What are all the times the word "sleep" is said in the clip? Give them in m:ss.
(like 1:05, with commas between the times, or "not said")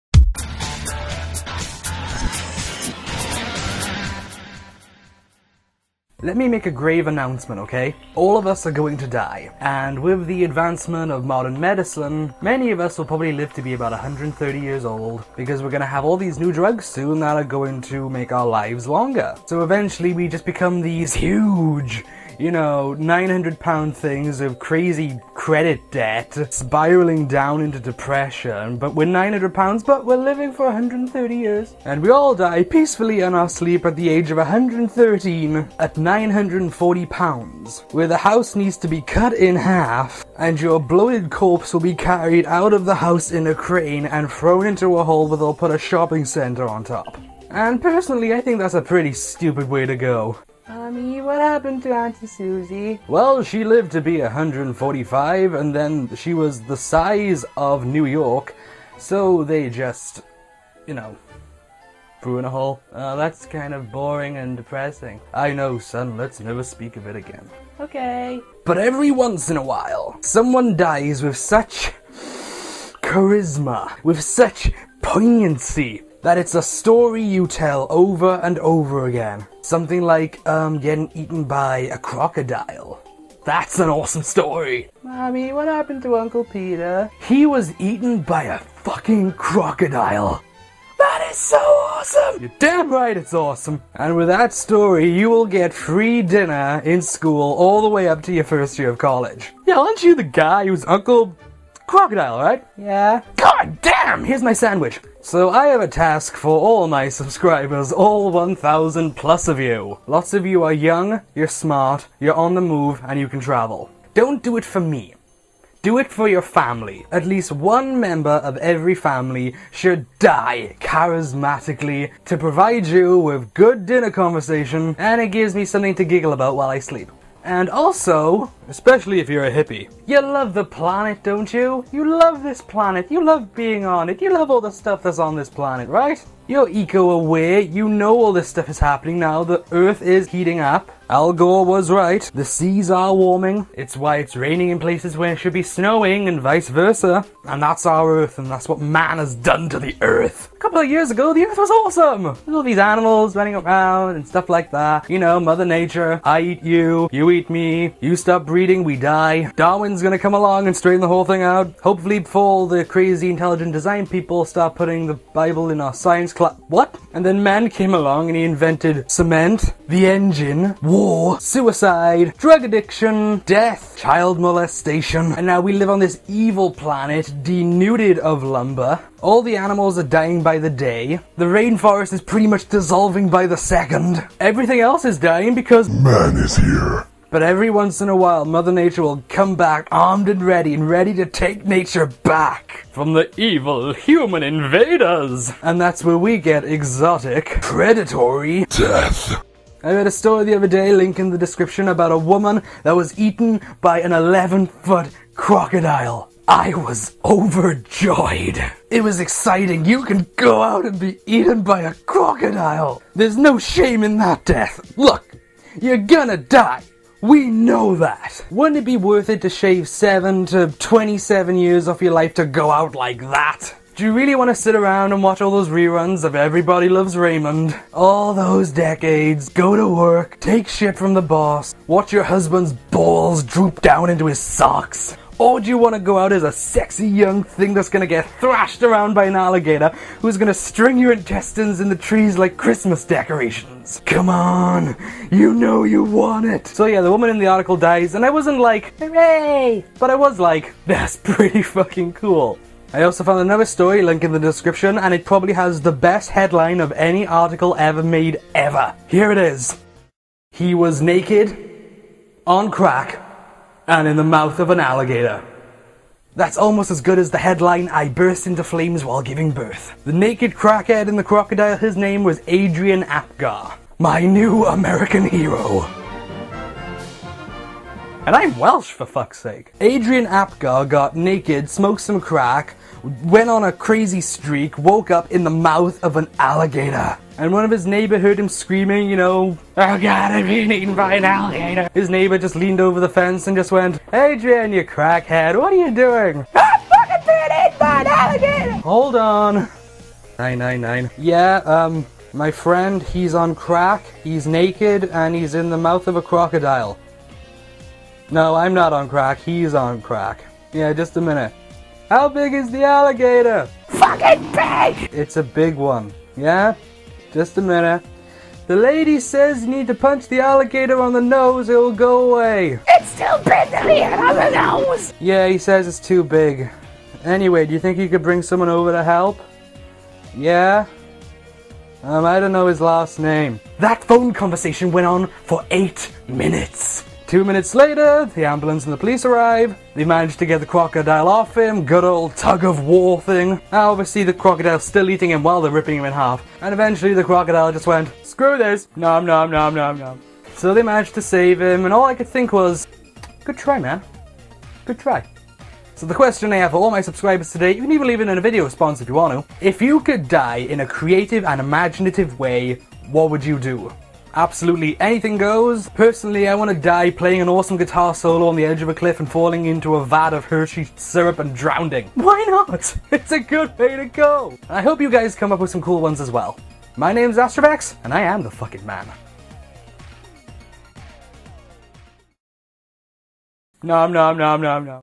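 0:33, 2:06.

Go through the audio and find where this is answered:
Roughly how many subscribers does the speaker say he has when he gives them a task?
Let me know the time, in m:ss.
1:48.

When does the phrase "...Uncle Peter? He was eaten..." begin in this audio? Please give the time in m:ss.
1:26.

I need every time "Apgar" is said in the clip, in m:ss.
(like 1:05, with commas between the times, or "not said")
4:33, 4:40.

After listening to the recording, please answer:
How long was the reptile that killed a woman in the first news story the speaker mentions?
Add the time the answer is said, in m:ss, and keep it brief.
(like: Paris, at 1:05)
11 foot, at 3:24.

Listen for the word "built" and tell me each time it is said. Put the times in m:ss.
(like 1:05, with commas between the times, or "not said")
not said.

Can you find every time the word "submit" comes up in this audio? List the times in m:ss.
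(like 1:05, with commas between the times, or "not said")
not said.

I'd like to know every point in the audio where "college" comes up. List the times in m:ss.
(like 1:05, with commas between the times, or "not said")
1:38.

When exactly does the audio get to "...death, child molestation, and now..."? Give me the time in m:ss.
2:53.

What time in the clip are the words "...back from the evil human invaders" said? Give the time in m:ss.
3:12.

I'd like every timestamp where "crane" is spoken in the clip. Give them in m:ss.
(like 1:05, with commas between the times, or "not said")
0:43.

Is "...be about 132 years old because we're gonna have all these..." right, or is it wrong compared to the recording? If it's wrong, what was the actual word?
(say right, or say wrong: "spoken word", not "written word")
wrong: "130", not "132".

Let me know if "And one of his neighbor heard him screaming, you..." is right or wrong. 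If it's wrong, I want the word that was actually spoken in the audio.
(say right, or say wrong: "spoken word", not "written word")
right.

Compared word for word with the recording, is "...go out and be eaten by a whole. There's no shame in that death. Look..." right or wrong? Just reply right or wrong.
wrong.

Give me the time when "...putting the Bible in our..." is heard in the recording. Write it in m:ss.
2:44.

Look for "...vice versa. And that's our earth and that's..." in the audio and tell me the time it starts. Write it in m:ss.
2:26.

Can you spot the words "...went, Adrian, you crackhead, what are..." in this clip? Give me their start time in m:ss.
4:53.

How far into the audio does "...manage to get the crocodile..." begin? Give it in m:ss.
5:40.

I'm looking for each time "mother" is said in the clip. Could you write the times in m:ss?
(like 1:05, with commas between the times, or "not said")
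2:35, 3:08.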